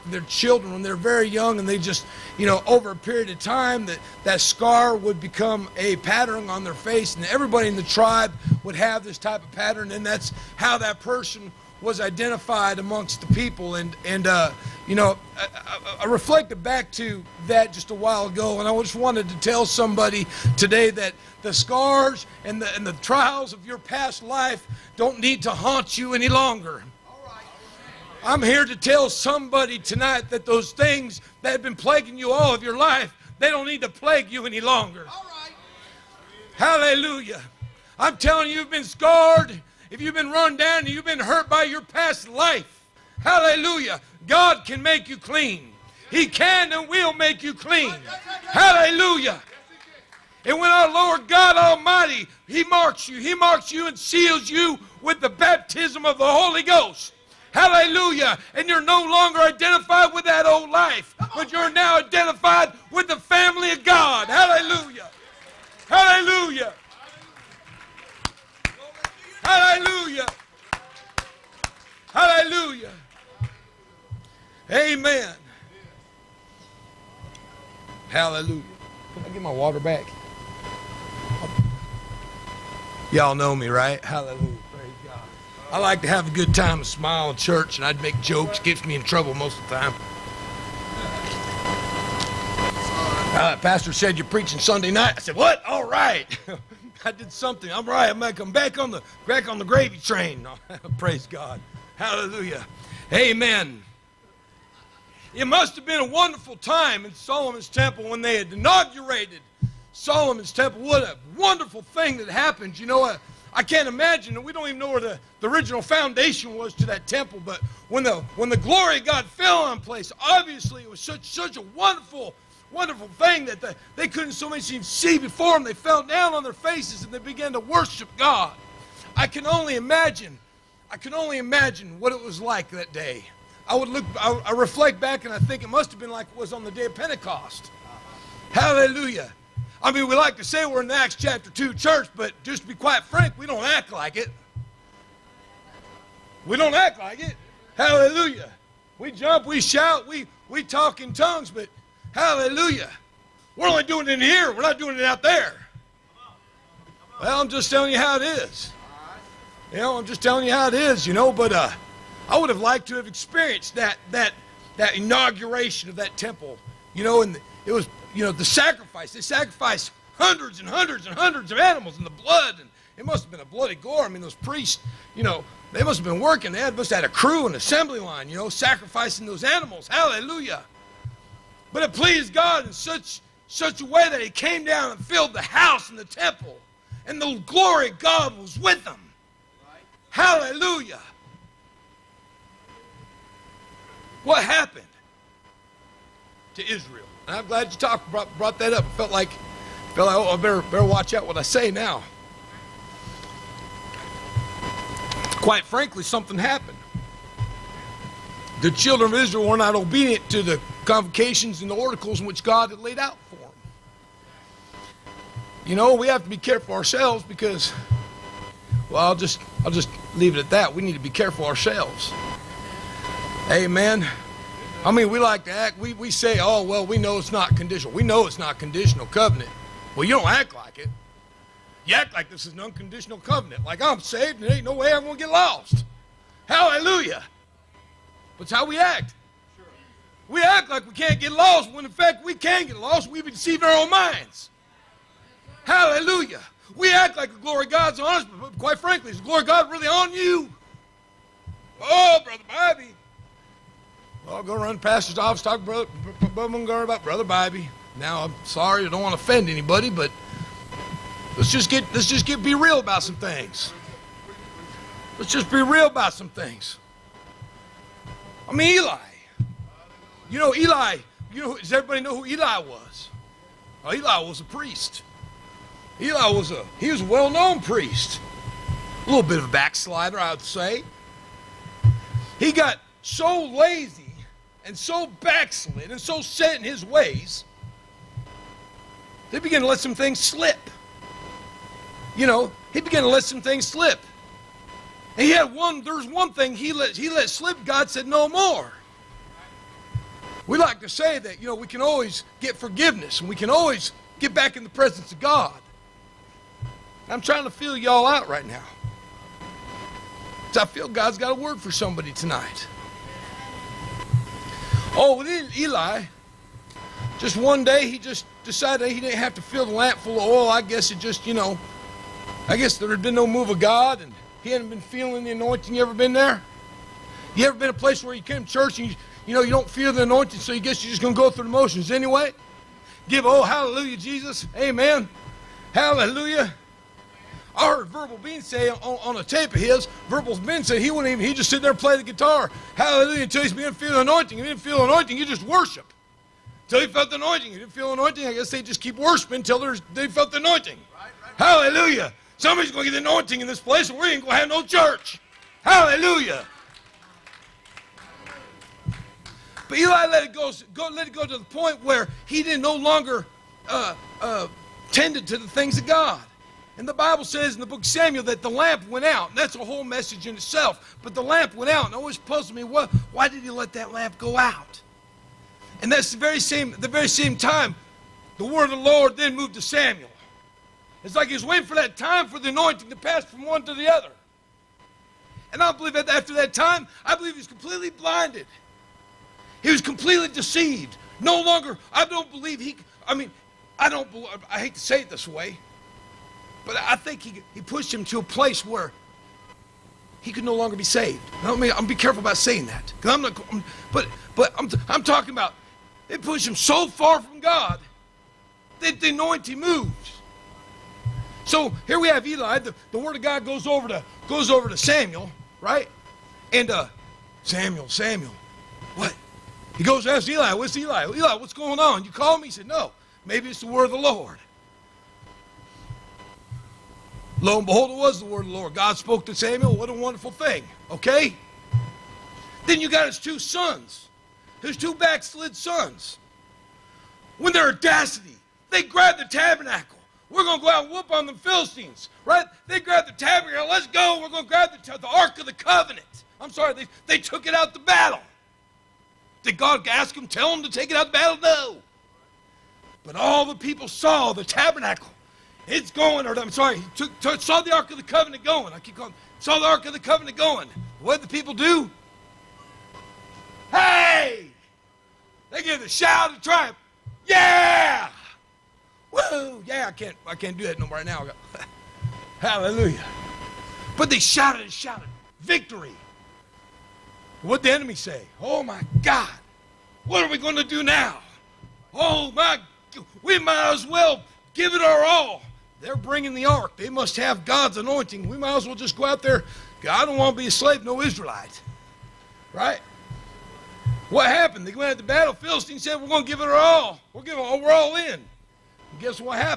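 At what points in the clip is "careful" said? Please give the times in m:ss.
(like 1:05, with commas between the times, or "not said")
3:36, 3:41, 6:41.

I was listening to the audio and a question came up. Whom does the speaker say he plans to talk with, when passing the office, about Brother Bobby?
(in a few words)
Brother Montgomery.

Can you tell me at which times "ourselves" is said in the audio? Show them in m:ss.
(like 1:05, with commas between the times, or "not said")
3:36, 3:41.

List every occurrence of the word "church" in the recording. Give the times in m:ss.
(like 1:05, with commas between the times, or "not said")
1:27, 2:21, 5:28, 5:54.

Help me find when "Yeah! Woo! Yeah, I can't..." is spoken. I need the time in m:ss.
7:47.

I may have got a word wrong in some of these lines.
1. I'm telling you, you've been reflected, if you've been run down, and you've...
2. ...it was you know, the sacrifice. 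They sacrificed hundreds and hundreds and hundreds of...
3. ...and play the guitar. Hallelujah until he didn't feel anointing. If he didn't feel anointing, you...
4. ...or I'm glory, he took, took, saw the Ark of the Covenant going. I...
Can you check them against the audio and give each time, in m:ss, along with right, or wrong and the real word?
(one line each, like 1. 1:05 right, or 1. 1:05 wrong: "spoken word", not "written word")
1. 0:37 wrong: "scarred", not "reflected"
2. 2:47 right
3. 5:41 right
4. 7:36 wrong: "sorry", not "glory".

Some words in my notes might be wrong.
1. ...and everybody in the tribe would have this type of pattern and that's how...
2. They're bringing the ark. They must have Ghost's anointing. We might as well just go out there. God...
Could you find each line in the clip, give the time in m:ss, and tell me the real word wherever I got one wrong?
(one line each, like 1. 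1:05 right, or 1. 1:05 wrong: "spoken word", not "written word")
1. 0:07 right
2. 8:05 wrong: "God", not "Ghost".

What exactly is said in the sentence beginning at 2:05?
They fell down on their faces and they began to worship God.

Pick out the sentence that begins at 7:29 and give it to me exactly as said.
Did God ask them, tell them to take it out the battle?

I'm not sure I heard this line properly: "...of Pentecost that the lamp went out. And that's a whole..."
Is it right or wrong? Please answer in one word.
wrong.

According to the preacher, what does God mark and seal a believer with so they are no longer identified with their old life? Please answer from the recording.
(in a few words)
Baptism of the Holy Ghost.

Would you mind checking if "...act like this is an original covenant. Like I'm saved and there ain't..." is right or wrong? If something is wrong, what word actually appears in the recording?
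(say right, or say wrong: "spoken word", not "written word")
wrong: "unconditional", not "original".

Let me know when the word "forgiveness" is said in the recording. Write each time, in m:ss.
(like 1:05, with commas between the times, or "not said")
5:02.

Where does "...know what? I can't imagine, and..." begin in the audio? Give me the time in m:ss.
1:52.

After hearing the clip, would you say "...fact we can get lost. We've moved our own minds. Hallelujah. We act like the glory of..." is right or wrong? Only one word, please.
wrong.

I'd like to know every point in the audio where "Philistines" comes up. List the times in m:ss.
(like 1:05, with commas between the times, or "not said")
7:21, 8:15.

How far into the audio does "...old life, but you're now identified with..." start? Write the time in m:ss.
1:00.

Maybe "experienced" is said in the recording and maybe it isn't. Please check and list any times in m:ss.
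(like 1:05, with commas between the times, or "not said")
2:43.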